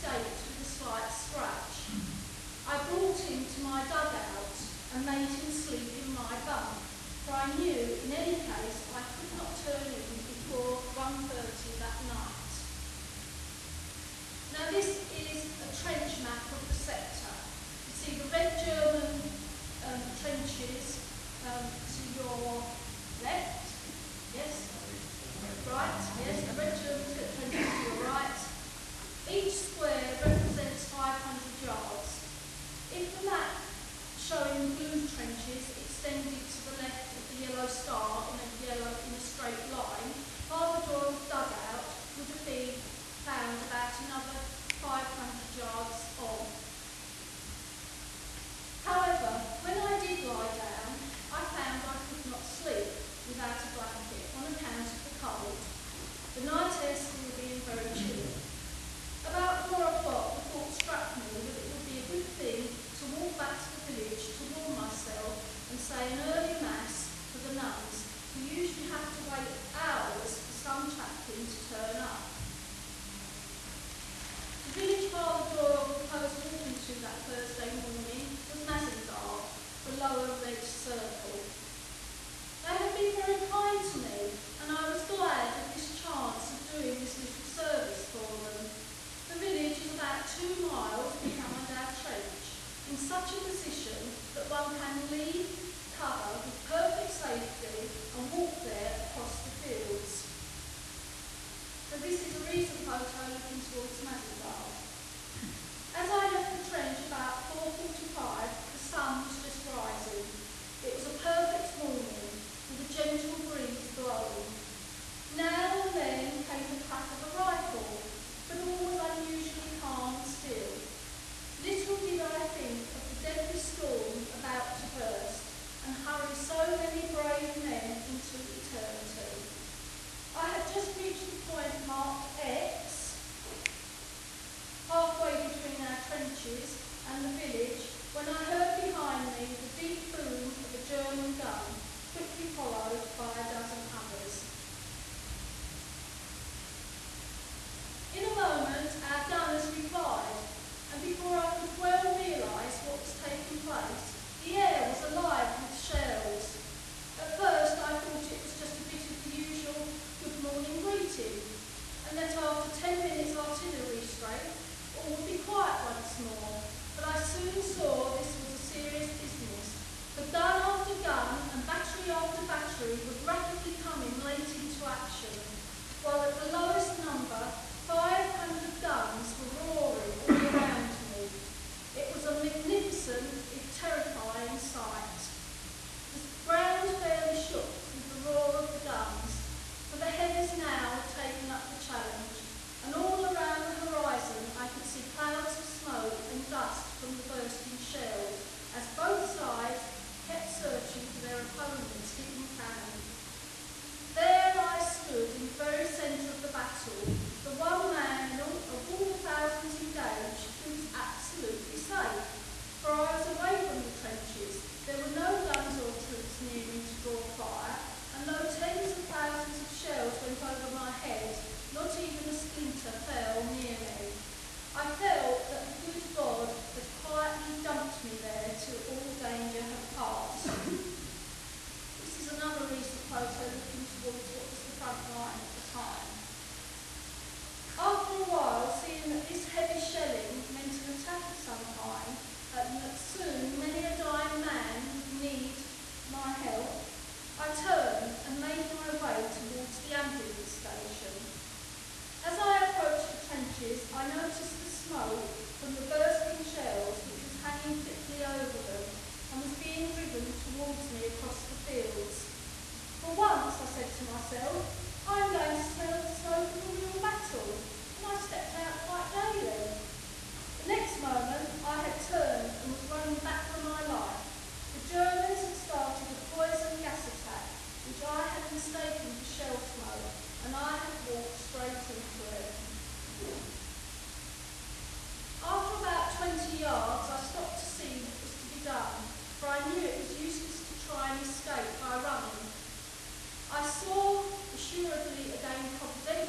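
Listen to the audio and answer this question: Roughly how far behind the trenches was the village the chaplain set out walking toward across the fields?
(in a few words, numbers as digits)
2 miles.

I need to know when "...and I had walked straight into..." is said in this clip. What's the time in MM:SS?
04:40.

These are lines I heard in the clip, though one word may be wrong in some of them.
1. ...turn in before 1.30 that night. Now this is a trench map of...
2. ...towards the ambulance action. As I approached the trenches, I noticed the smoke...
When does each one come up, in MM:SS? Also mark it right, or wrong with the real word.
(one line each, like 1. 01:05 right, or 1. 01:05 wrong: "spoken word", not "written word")
1. 00:09 right
2. 04:09 wrong: "station", not "action".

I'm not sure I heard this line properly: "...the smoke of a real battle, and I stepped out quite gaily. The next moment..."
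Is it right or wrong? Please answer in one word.
right.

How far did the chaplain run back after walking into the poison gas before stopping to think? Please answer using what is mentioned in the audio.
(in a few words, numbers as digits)
20 yards.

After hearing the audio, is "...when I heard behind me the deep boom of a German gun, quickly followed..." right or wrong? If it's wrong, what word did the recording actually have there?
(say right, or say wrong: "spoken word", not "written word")
right.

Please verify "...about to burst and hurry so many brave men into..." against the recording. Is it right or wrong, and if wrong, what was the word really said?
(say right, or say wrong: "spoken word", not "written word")
right.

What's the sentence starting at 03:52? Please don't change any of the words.
this is another recent photo looking towards what was the front line at the time.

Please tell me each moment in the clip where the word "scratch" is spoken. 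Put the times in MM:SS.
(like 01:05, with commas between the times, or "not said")
00:01.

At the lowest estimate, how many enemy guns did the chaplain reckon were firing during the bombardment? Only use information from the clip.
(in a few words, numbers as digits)
500.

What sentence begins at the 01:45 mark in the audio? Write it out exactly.
As I left the trench about 4.45, the sun was just rising.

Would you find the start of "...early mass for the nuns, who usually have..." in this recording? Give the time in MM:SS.
01:06.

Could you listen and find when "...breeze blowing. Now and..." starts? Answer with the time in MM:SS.
01:53.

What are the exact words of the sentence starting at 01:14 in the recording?
The village father Doyle proposed walking to that Thursday morning was Mazingarbe, the lower red circle.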